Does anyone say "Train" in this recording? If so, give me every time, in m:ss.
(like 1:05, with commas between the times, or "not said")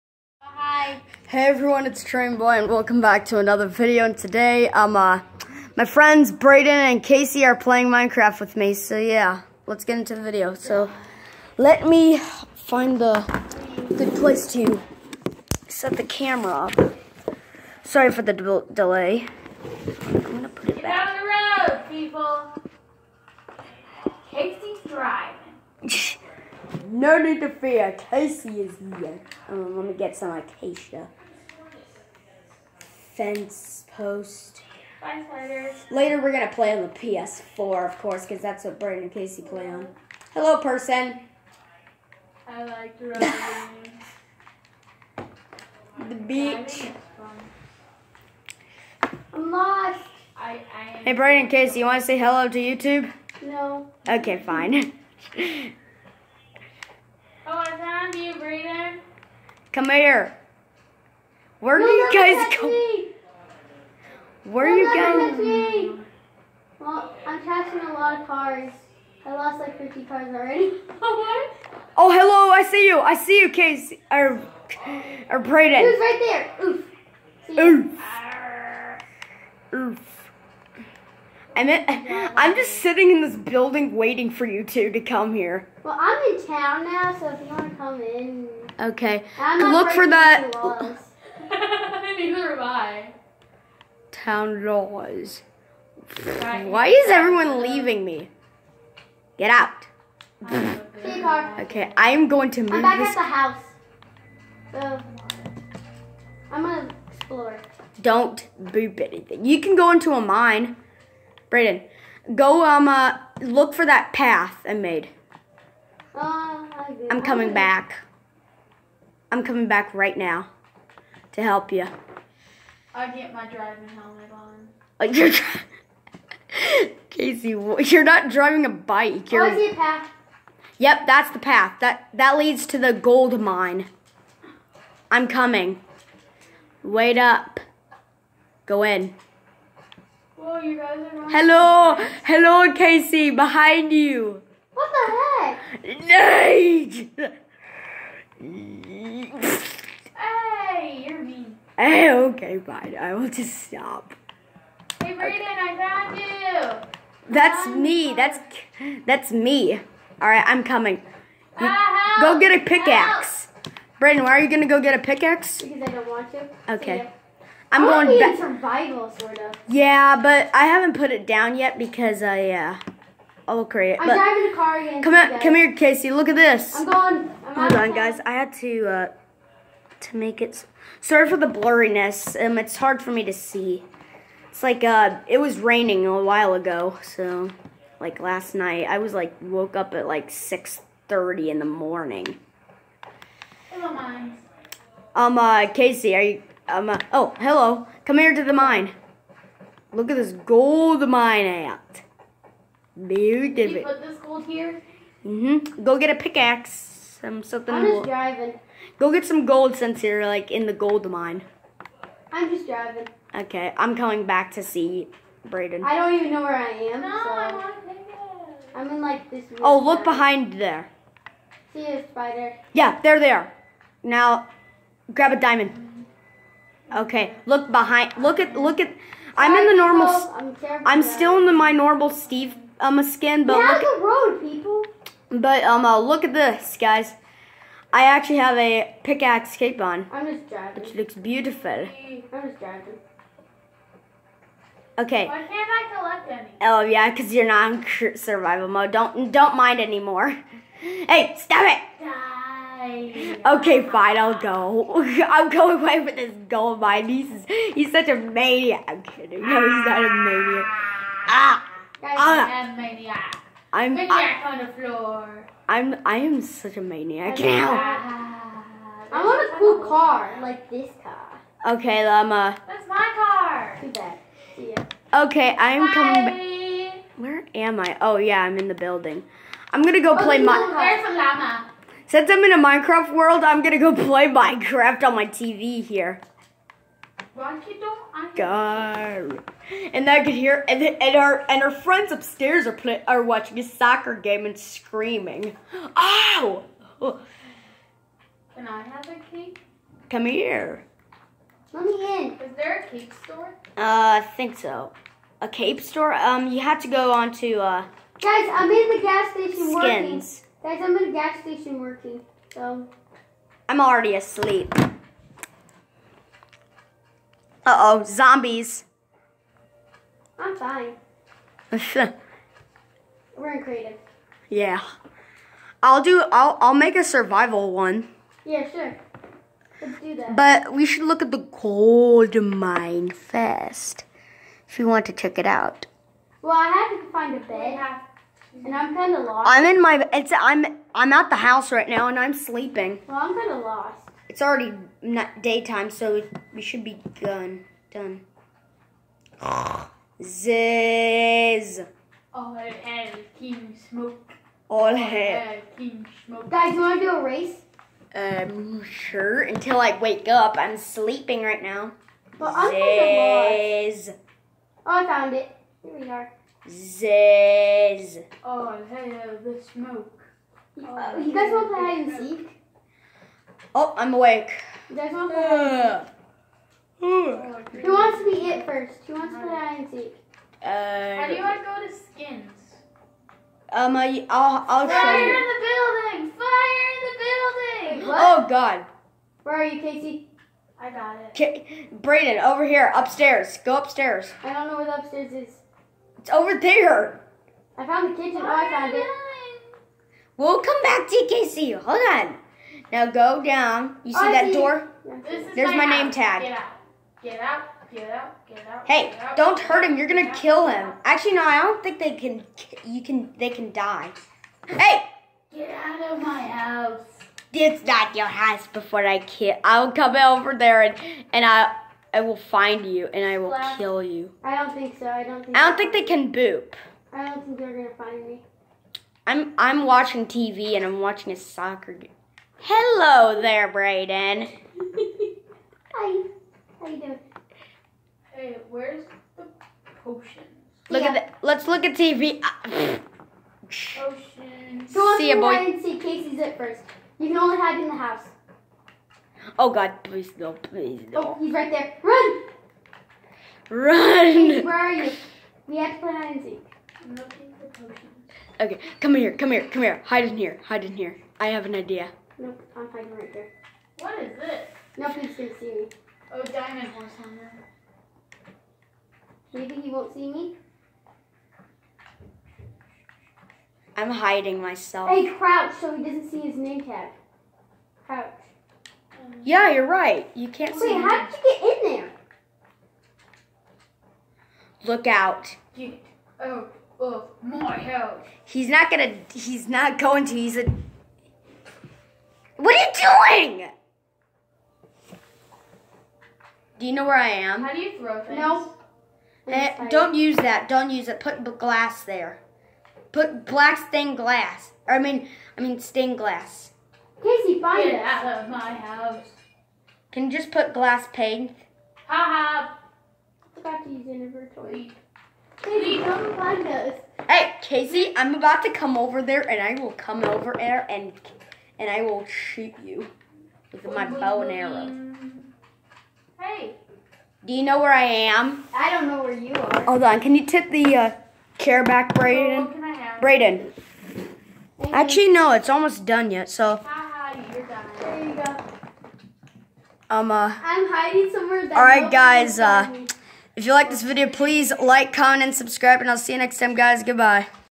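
0:02.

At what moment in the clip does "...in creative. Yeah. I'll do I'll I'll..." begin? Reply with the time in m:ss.
5:23.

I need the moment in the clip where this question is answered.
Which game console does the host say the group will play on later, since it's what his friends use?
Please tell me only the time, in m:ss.
0:36.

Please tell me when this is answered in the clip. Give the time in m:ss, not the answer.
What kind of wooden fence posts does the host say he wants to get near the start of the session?
0:30.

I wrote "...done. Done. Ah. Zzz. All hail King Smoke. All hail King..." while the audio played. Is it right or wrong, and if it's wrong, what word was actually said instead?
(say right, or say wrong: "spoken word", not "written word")
right.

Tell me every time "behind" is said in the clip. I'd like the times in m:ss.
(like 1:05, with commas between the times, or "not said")
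2:23, 3:40, 3:47.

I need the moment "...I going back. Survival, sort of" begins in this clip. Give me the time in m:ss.
2:47.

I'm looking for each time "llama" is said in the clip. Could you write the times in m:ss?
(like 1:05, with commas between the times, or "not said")
4:32, 4:41.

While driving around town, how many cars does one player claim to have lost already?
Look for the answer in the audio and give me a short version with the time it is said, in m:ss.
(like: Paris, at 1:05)
50, at 1:09.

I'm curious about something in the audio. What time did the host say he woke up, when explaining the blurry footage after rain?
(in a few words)
6:30.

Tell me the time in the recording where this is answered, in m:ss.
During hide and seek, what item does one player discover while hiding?
7:46.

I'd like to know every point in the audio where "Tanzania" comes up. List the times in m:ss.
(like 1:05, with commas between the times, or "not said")
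not said.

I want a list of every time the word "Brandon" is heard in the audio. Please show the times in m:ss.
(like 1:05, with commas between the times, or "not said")
0:38, 0:51, 0:58.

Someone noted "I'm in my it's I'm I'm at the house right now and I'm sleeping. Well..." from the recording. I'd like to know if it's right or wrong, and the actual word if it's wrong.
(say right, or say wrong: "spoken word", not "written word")
right.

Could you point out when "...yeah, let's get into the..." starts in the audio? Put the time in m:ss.
0:08.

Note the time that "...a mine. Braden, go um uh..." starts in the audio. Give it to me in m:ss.
1:50.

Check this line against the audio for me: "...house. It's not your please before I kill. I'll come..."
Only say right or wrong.
wrong.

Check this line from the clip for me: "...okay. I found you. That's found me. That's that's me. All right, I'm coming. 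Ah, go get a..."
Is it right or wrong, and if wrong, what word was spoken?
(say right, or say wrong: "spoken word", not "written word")
right.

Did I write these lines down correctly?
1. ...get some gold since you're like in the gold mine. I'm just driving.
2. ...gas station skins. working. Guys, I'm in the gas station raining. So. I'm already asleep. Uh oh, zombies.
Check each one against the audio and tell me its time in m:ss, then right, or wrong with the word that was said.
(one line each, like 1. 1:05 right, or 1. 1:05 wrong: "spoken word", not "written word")
1. 3:29 right
2. 5:09 wrong: "working", not "raining".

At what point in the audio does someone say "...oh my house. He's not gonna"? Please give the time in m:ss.
8:06.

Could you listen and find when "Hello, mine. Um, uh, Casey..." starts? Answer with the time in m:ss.
3:13.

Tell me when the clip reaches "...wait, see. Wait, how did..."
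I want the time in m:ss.
8:00.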